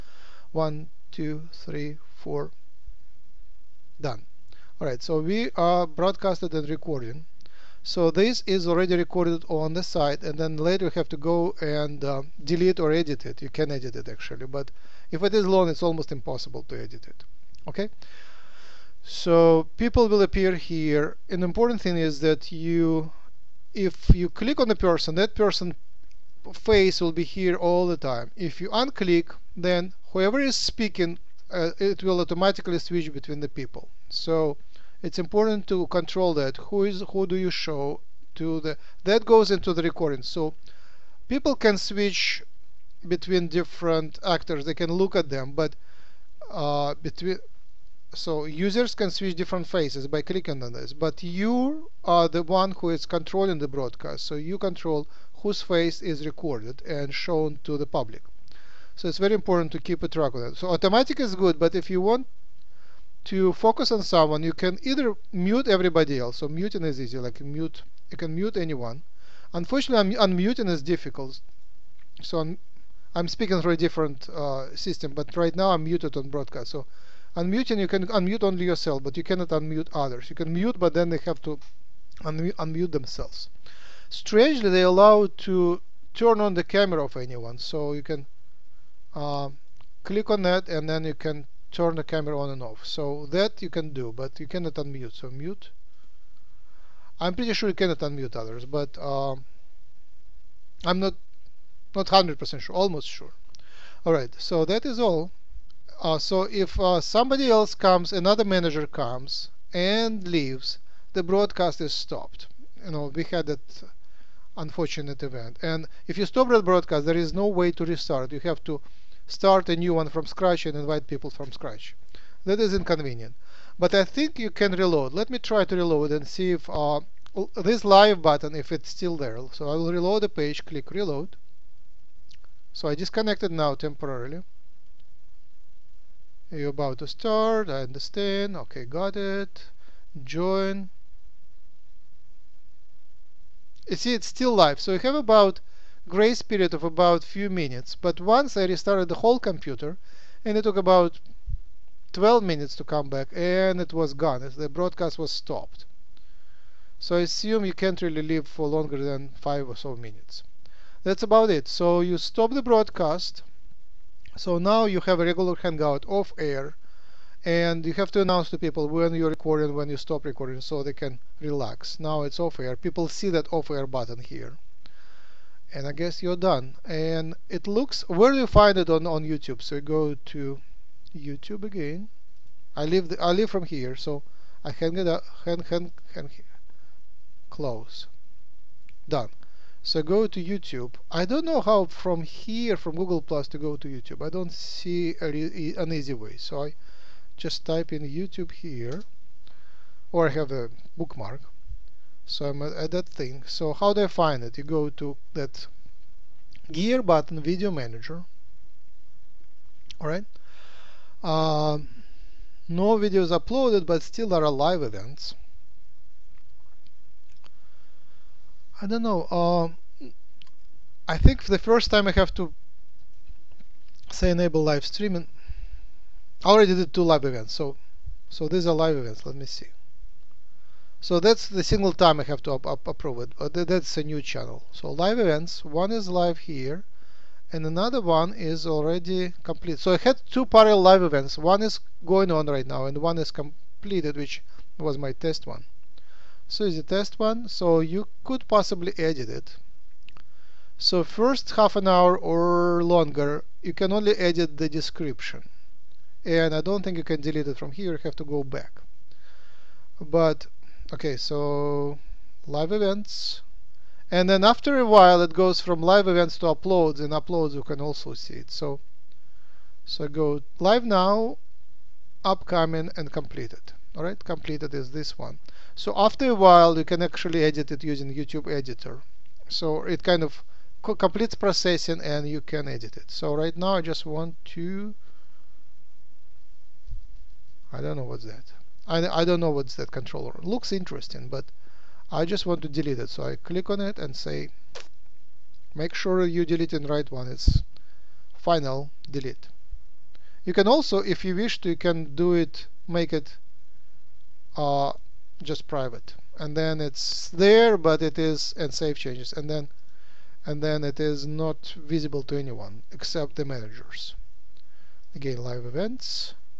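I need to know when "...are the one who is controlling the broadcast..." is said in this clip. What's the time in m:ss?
0:52.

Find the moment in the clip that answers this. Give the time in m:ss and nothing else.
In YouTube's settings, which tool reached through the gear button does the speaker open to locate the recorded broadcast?
3:27.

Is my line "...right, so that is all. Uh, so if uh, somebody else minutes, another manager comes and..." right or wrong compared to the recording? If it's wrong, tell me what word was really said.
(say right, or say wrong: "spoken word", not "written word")
wrong: "comes", not "minutes".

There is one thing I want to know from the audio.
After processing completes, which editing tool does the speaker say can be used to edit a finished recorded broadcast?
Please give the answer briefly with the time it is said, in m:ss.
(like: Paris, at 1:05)
YouTube editor, at 4:38.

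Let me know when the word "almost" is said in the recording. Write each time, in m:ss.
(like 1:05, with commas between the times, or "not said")
0:15, 1:42.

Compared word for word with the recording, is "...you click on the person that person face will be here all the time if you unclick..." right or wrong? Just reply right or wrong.
right.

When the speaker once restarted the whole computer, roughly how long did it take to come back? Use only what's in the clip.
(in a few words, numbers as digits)
12 minutes.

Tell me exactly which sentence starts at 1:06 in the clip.
So muting is easy, like mute, you can mute anyone.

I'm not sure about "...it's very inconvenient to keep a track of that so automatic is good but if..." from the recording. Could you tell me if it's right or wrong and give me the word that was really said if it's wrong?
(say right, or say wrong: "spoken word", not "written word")
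wrong: "important", not "inconvenient".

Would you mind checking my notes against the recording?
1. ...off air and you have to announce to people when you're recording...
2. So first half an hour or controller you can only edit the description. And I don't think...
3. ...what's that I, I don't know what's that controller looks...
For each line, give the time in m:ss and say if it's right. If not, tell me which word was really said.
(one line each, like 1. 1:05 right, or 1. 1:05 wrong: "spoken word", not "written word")
1. 2:46 right
2. 4:10 wrong: "longer", not "controller"
3. 4:48 right.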